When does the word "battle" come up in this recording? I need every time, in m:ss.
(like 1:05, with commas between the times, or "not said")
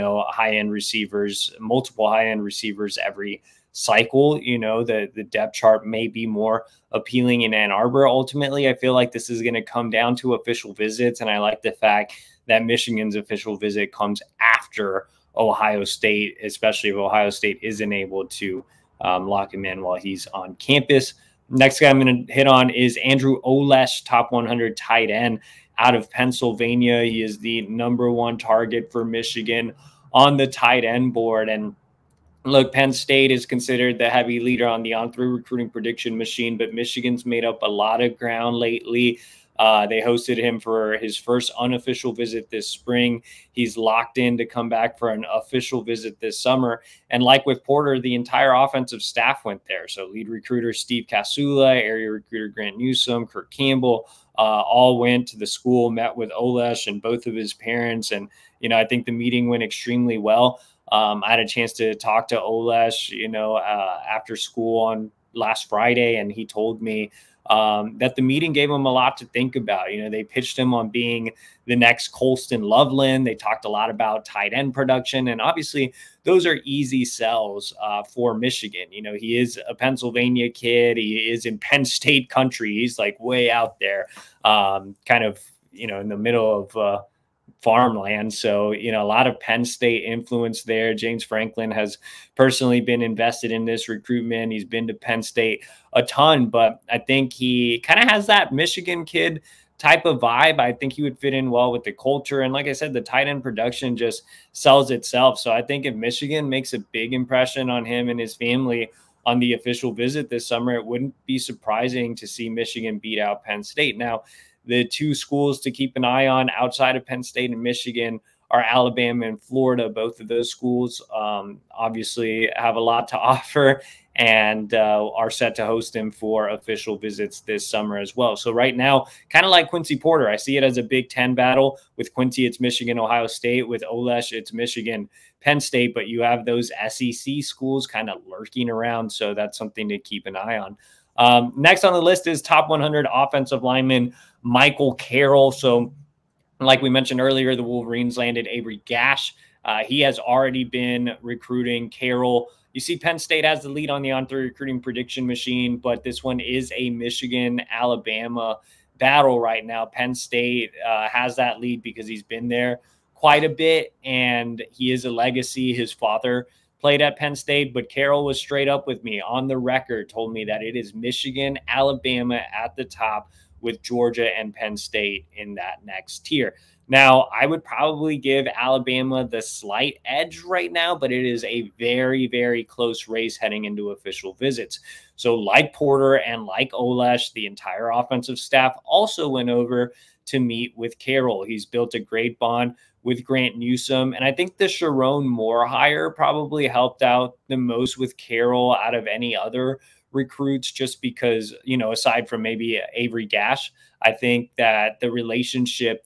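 2:11, 2:38.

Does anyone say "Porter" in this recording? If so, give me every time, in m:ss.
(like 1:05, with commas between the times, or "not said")
0:47, 2:09, 3:05.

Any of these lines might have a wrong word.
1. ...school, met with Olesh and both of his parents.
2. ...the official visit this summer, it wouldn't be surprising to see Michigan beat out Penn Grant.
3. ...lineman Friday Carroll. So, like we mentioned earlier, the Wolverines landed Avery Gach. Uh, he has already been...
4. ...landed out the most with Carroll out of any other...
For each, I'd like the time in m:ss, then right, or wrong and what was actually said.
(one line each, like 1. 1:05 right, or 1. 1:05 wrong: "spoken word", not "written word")
1. 0:55 right
2. 1:49 wrong: "State", not "Grant"
3. 2:23 wrong: "Michael", not "Friday"
4. 3:16 wrong: "helped", not "landed".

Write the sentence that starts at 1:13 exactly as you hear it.
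They talked a lot about tight end production, and obviously those are easy sells uh, for Michigan.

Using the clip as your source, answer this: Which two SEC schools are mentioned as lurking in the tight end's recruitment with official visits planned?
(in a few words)
Alabama and Florida.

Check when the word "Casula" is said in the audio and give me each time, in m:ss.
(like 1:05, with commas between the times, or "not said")
0:51.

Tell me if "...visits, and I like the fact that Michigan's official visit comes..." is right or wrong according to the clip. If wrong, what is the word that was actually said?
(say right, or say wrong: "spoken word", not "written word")
right.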